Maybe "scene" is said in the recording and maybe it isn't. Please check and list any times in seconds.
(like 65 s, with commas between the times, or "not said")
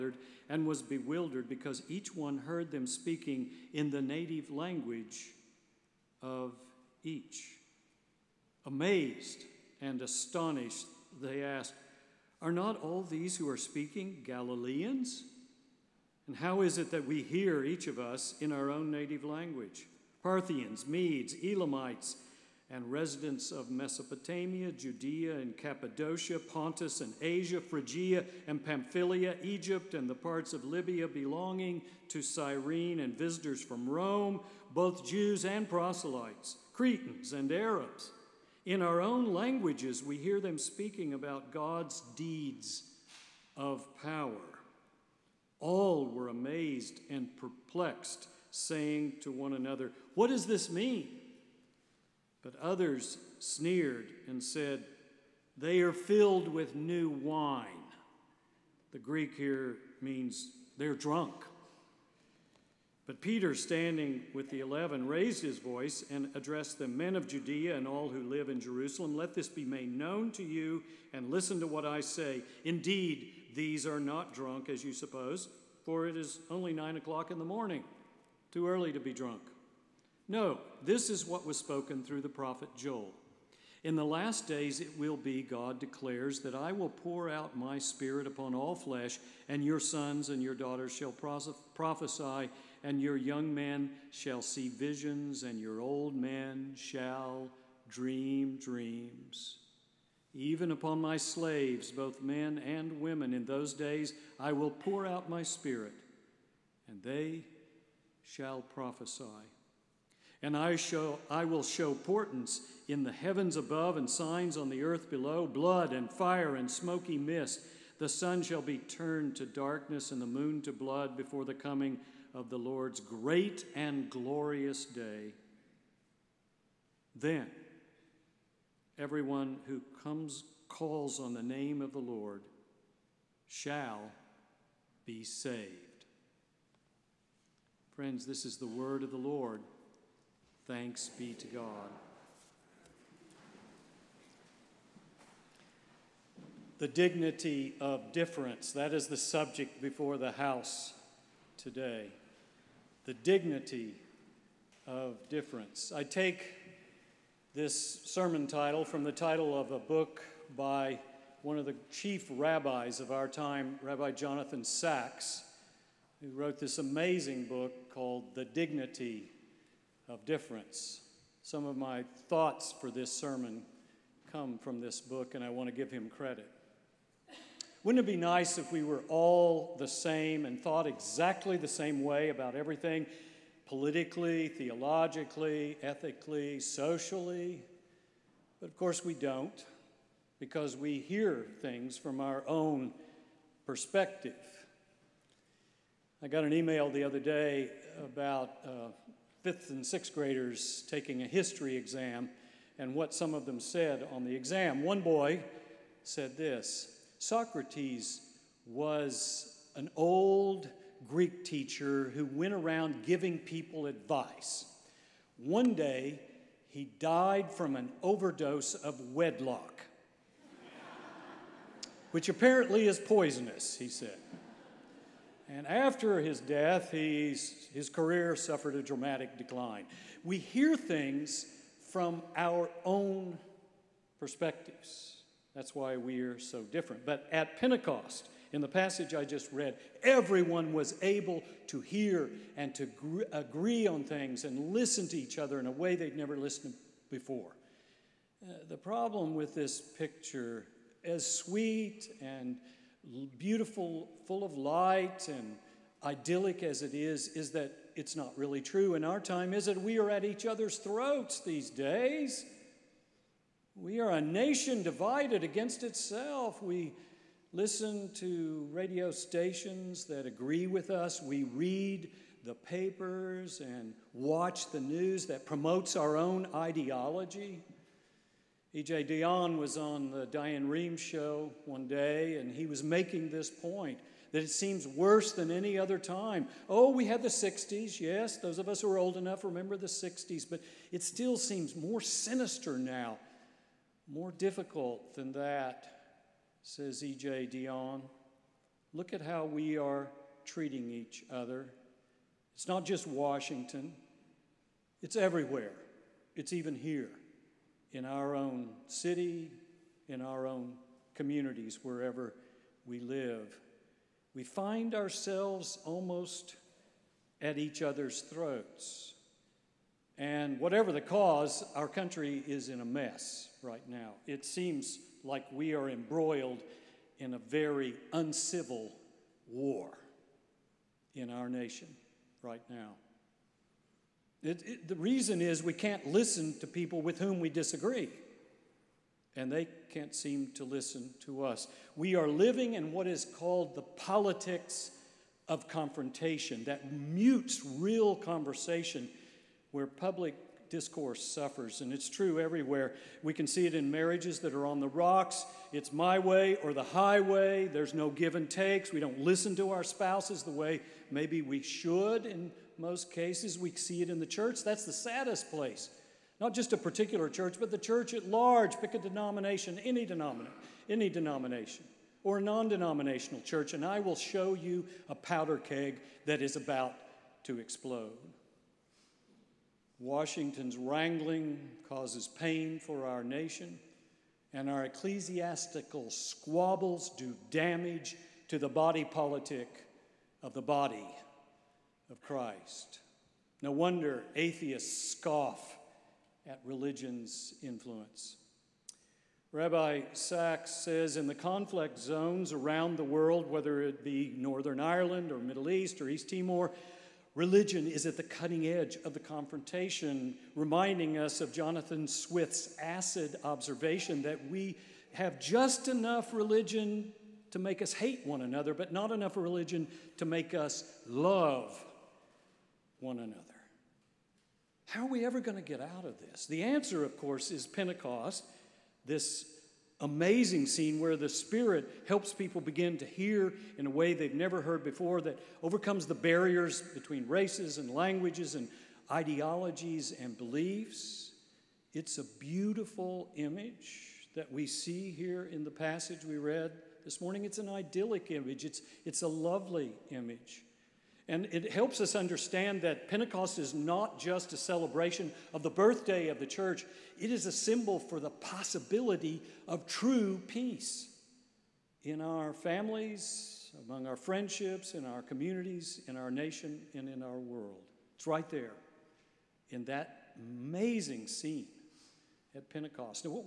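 430 s, 471 s.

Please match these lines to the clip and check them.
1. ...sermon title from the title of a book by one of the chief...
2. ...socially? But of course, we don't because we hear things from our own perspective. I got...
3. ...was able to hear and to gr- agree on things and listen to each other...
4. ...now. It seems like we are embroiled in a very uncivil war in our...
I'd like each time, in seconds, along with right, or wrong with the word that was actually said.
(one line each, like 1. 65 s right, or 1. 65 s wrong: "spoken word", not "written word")
1. 158 s right
2. 186 s right
3. 240 s right
4. 323 s right.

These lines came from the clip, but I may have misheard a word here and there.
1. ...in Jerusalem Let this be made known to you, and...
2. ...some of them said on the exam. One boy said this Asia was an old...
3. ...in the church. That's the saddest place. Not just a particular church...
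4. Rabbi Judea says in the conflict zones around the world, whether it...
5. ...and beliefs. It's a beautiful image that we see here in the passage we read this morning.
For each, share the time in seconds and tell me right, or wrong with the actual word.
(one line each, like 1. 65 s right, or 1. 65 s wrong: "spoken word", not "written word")
1. 68 s right
2. 203 s wrong: "Socrates", not "Asia"
3. 364 s right
4. 399 s wrong: "Sacks", not "Judea"
5. 440 s right.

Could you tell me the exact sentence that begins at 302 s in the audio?
It's not just Washington, it's everywhere, it's even here in our own city, in our own communities, wherever we live.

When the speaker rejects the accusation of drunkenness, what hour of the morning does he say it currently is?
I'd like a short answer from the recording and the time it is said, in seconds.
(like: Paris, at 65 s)
9 o'clock, at 76 s.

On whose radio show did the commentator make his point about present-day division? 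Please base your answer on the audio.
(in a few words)
Diane Rehm.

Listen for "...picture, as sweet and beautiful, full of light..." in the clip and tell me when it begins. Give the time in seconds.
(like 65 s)
249 s.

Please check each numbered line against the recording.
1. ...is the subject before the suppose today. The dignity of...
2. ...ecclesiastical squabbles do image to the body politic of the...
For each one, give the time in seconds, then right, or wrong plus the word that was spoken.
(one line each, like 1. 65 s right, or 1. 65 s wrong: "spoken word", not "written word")
1. 148 s wrong: "house", not "suppose"
2. 384 s wrong: "damage", not "image".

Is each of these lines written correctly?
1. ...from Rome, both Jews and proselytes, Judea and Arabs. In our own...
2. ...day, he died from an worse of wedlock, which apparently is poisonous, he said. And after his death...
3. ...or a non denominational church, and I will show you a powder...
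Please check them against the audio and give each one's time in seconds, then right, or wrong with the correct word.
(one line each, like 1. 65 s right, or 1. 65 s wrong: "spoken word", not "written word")
1. 33 s wrong: "Cretans", not "Judea"
2. 215 s wrong: "overdose", not "worse"
3. 372 s right.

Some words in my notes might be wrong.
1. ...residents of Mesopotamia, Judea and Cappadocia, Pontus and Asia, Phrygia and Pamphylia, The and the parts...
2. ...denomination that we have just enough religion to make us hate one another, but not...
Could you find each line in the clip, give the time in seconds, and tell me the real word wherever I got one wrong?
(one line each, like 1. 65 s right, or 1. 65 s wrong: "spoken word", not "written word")
1. 22 s wrong: "Egypt", not "The"
2. 413 s wrong: "observation", not "denomination".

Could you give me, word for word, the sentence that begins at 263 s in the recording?
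We are a nation divided against itself.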